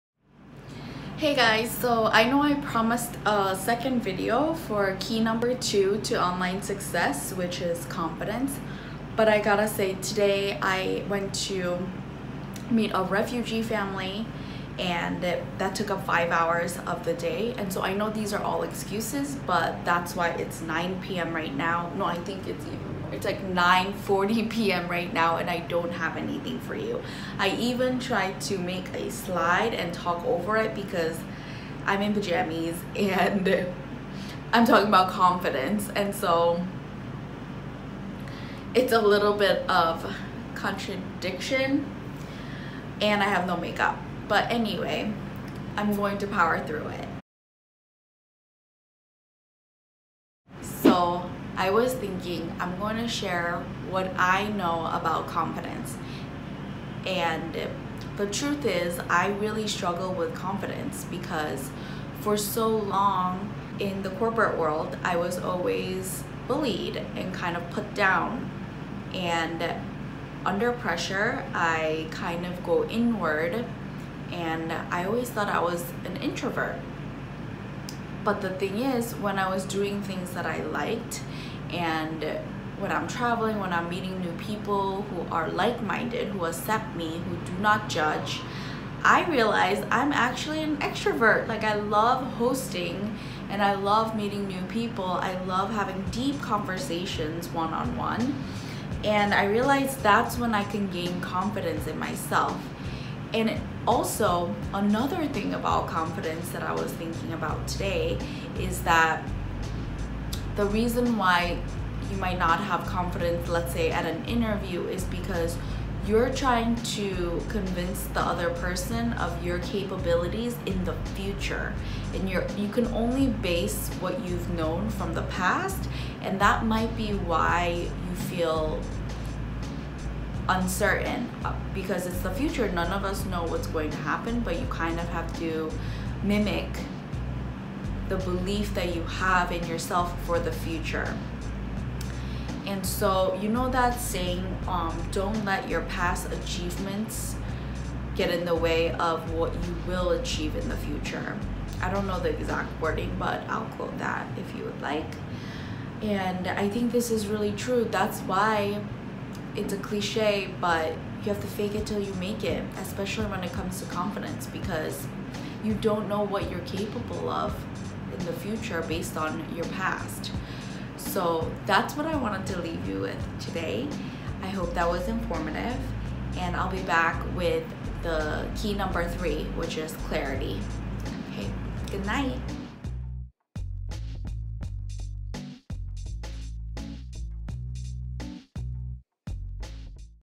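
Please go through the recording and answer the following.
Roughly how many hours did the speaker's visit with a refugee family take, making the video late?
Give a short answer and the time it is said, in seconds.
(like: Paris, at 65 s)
5, at 16 s.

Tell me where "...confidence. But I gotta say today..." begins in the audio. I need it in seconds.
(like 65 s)
7 s.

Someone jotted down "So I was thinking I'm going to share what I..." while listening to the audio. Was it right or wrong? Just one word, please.
right.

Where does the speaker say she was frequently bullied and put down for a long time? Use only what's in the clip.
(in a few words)
The corporate world.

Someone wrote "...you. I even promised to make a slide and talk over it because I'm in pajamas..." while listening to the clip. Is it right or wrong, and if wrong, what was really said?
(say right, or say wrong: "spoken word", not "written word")
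wrong: "tried", not "promised".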